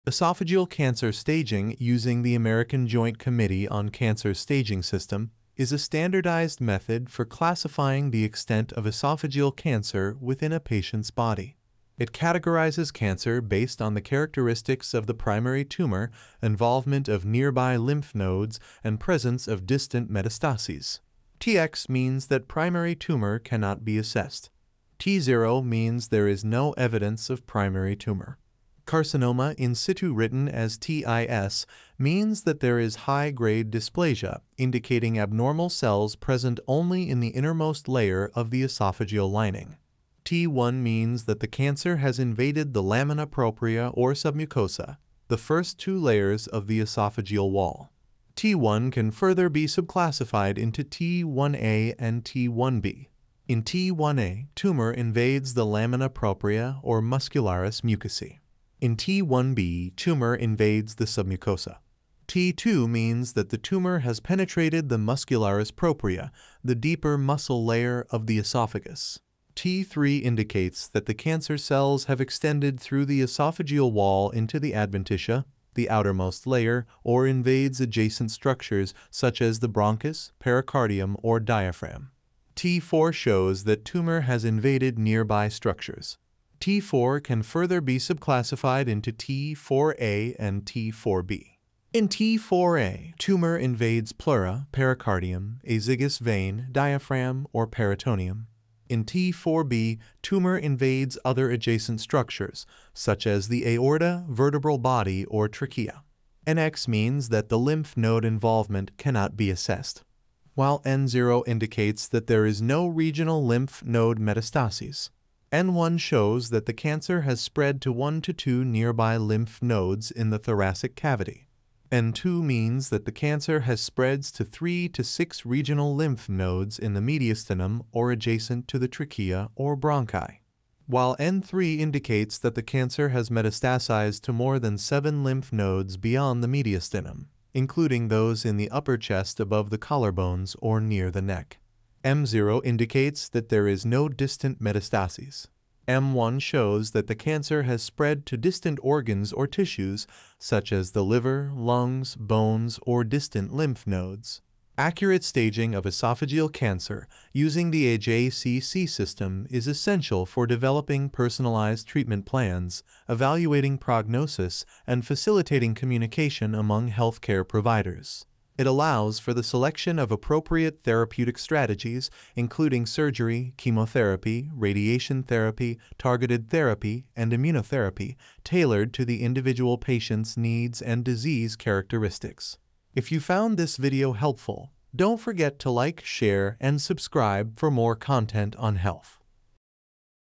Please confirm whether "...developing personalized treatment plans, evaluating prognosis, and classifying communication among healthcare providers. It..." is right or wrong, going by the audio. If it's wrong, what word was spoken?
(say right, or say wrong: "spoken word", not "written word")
wrong: "facilitating", not "classifying".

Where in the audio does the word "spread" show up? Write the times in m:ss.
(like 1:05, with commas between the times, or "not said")
1:57, 2:03, 2:27.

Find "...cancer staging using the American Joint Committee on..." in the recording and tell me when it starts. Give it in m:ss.
0:00.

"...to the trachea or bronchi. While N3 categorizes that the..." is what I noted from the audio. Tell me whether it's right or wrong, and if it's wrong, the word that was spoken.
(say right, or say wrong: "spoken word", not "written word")
wrong: "indicates", not "categorizes".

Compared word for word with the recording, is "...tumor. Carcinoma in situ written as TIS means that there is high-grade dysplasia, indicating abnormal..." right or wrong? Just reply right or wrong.
right.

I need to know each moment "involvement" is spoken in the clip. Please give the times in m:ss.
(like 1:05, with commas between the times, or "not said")
0:16, 1:48.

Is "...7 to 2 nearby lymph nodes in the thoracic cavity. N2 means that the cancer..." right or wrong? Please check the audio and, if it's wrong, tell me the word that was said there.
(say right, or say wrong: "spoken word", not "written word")
wrong: "1", not "7".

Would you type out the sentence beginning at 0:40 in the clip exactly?
T1 means that the cancer has invaded the lamina propria or submucosa, the first two layers of the esophageal wall.